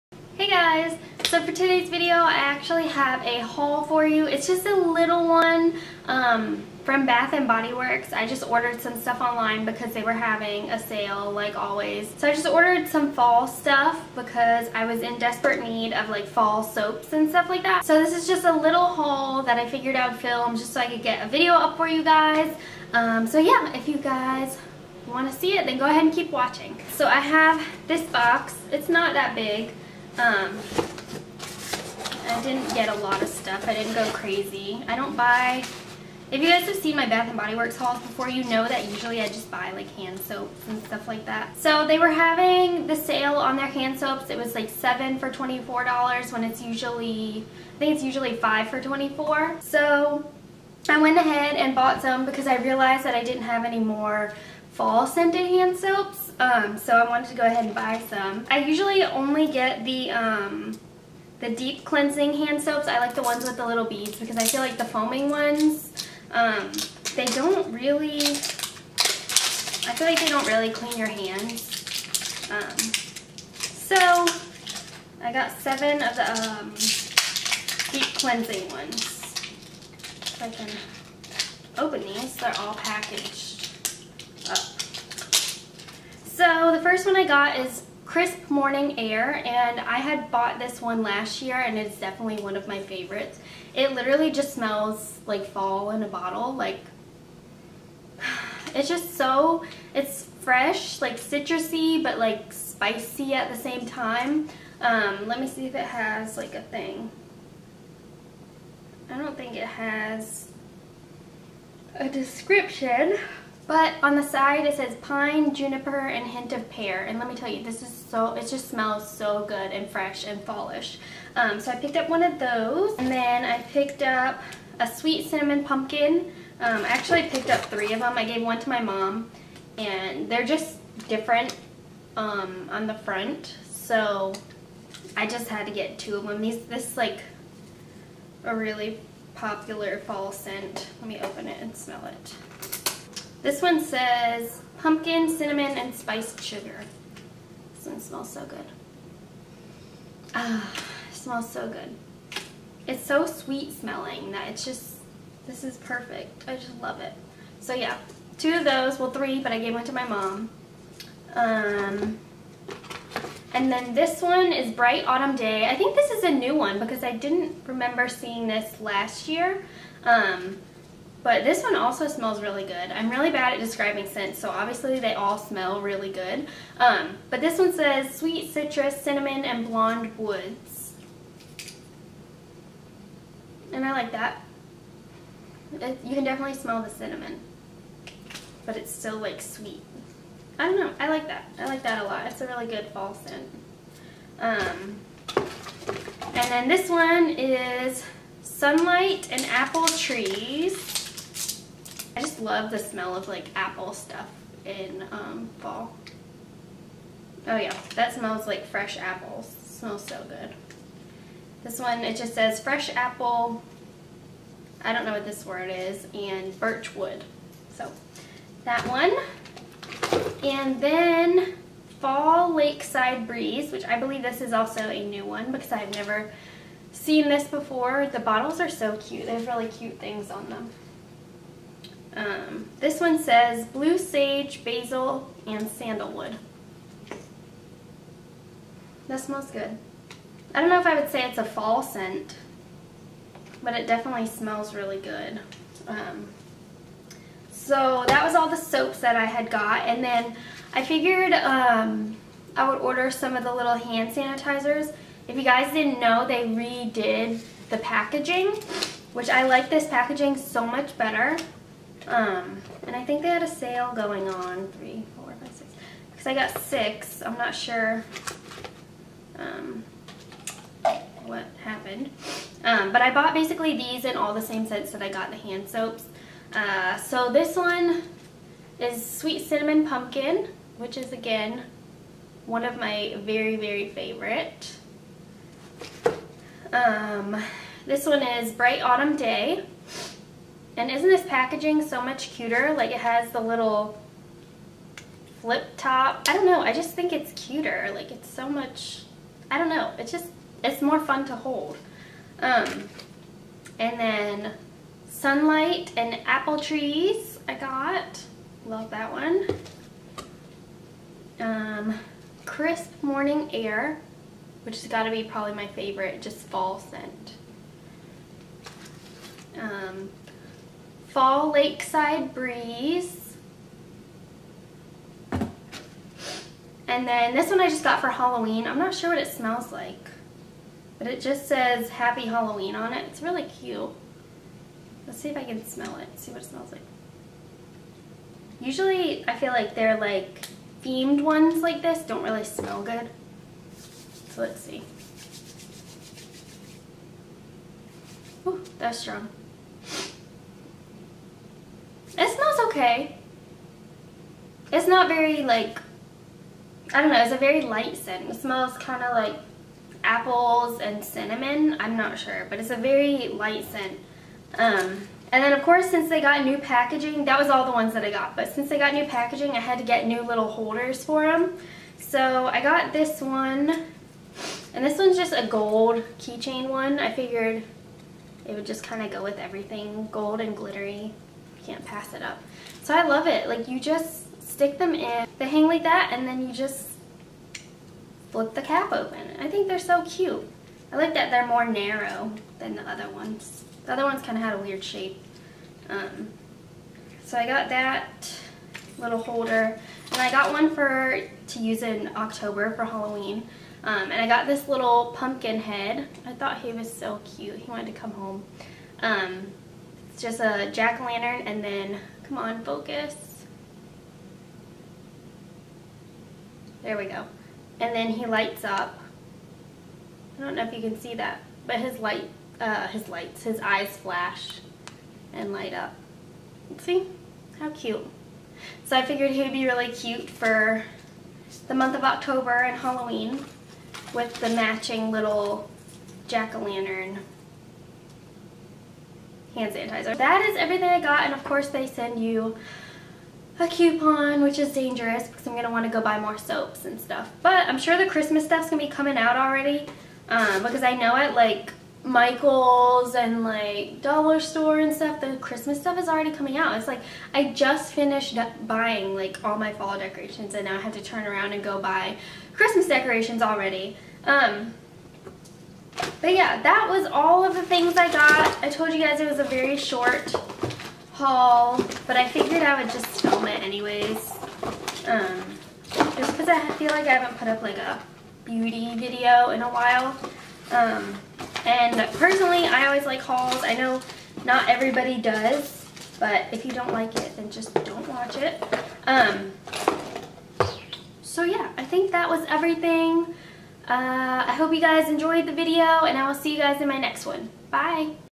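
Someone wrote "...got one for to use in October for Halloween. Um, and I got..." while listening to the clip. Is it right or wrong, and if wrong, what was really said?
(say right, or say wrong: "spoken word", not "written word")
right.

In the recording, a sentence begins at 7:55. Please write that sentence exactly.
Um, just because I feel like I haven't put up like a beauty video in a while.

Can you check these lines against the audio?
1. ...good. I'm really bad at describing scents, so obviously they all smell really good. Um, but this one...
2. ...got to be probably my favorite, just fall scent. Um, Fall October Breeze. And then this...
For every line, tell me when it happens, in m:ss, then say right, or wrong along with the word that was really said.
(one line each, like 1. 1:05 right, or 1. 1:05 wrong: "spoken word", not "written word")
1. 2:52 right
2. 5:14 wrong: "Lakeside", not "October".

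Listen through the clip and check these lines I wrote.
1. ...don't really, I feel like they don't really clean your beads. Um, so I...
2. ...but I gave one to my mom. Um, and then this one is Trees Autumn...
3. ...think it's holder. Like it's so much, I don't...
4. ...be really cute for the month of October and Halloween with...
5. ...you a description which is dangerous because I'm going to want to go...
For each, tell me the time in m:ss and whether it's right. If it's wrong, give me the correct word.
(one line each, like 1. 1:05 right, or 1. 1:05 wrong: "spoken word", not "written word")
1. 1:07 wrong: "hands", not "beads"
2. 2:39 wrong: "Bright", not "Trees"
3. 4:56 wrong: "cuter", not "holder"
4. 7:09 right
5. 7:22 wrong: "coupon", not "description".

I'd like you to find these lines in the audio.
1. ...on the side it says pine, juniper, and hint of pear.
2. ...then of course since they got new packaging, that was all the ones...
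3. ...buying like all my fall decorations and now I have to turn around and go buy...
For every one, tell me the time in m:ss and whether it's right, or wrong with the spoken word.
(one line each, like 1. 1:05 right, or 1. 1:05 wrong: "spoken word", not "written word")
1. 1:54 right
2. 6:05 right
3. 7:38 right.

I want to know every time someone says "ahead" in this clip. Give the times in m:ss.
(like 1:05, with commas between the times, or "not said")
0:25, 0:51, 0:57.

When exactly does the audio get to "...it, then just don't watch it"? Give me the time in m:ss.
8:07.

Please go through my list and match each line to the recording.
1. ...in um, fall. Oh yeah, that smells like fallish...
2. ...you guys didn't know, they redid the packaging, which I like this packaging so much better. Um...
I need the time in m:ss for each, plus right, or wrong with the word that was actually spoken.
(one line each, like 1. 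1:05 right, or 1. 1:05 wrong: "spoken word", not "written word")
1. 3:24 wrong: "fresh", not "fallish"
2. 4:15 right.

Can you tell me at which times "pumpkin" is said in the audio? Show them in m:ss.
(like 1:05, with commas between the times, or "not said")
2:05, 2:24, 4:39, 6:45.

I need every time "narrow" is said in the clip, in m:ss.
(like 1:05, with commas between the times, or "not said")
6:31.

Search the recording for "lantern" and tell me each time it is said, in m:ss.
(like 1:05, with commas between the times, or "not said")
6:50, 7:16.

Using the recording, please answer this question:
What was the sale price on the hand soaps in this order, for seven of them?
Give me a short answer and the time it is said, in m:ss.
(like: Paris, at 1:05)
$24, at 0:44.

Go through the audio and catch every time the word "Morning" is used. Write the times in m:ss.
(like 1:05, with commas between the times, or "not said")
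1:28, 5:13.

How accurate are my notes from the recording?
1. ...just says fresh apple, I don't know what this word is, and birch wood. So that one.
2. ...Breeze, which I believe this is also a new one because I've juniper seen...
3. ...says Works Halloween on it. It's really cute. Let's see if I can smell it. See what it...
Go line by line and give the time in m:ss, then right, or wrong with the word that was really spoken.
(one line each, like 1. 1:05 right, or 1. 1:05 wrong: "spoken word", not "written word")
1. 3:32 right
2. 3:43 wrong: "never", not "juniper"
3. 5:31 wrong: "Happy", not "Works".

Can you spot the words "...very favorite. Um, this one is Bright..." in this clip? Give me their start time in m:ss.
4:43.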